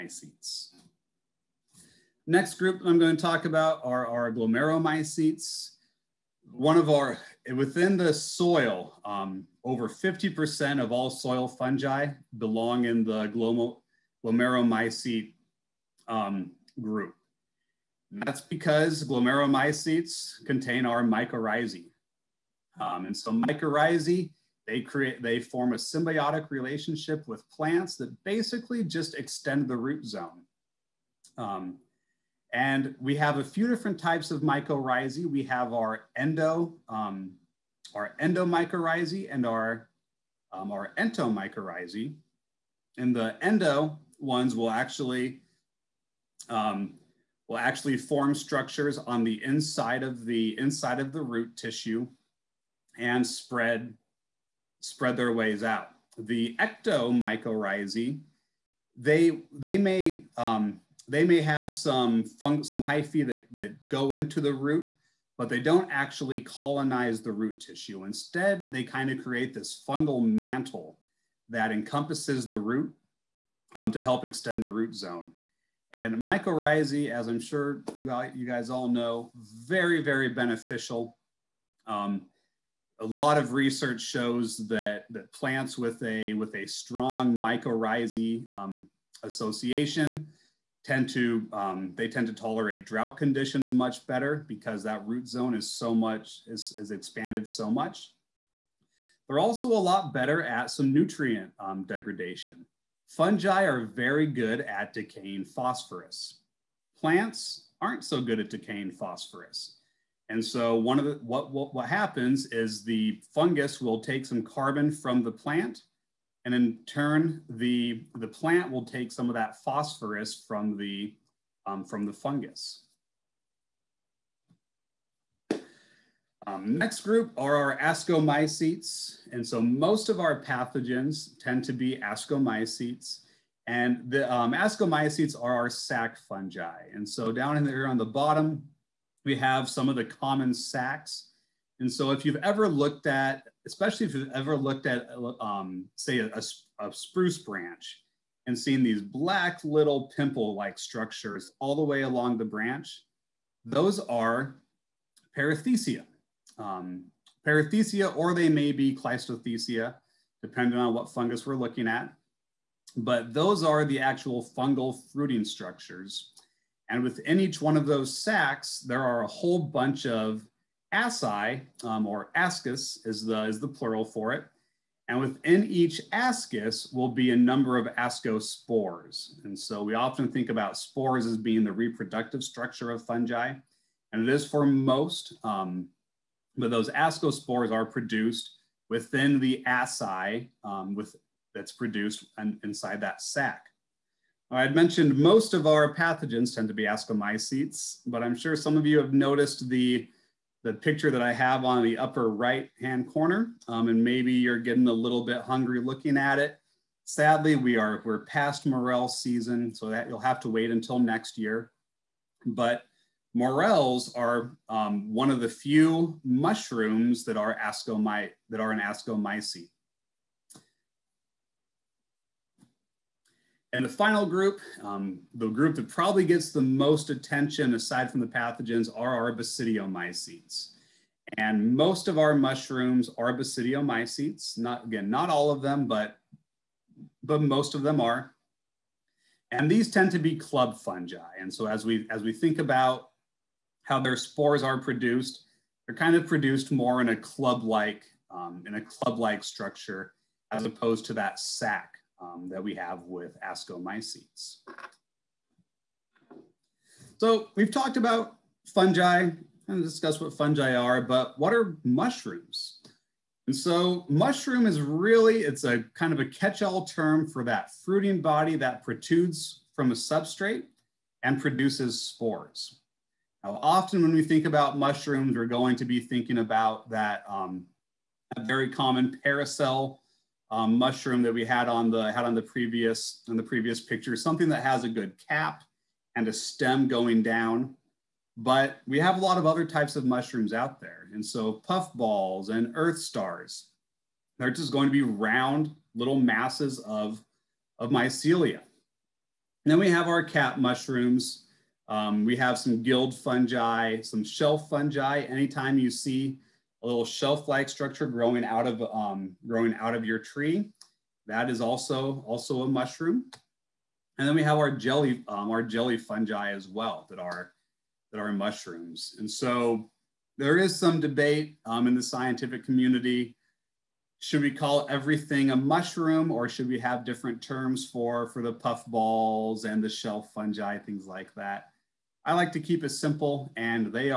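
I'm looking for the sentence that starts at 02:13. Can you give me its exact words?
And the um, ascomycetes are our sac fungi.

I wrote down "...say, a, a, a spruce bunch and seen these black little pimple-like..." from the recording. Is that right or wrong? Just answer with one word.
wrong.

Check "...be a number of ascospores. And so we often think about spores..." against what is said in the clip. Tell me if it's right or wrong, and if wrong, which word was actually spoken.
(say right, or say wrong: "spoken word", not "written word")
right.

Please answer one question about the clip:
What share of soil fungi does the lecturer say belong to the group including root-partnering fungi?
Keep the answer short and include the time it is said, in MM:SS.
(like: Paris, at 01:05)
over 50%, at 00:09.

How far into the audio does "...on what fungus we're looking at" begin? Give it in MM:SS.
02:40.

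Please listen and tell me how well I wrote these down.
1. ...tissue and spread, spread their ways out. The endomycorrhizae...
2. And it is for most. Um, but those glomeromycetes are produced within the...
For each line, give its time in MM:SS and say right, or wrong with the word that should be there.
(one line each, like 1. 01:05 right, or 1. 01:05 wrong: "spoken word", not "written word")
1. 00:51 wrong: "ectomycorrhizae", not "endomycorrhizae"
2. 03:04 wrong: "ascospores", not "glomeromycetes".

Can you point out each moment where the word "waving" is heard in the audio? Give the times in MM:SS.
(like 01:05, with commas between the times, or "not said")
not said.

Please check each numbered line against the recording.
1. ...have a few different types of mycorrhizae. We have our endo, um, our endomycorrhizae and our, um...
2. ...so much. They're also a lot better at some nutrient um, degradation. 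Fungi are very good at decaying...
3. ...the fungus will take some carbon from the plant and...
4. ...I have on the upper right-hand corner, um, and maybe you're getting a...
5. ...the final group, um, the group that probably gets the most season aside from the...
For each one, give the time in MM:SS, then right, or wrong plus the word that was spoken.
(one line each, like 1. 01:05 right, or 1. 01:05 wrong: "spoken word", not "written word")
1. 00:33 right
2. 01:37 right
3. 01:52 right
4. 03:21 right
5. 03:43 wrong: "attention", not "season".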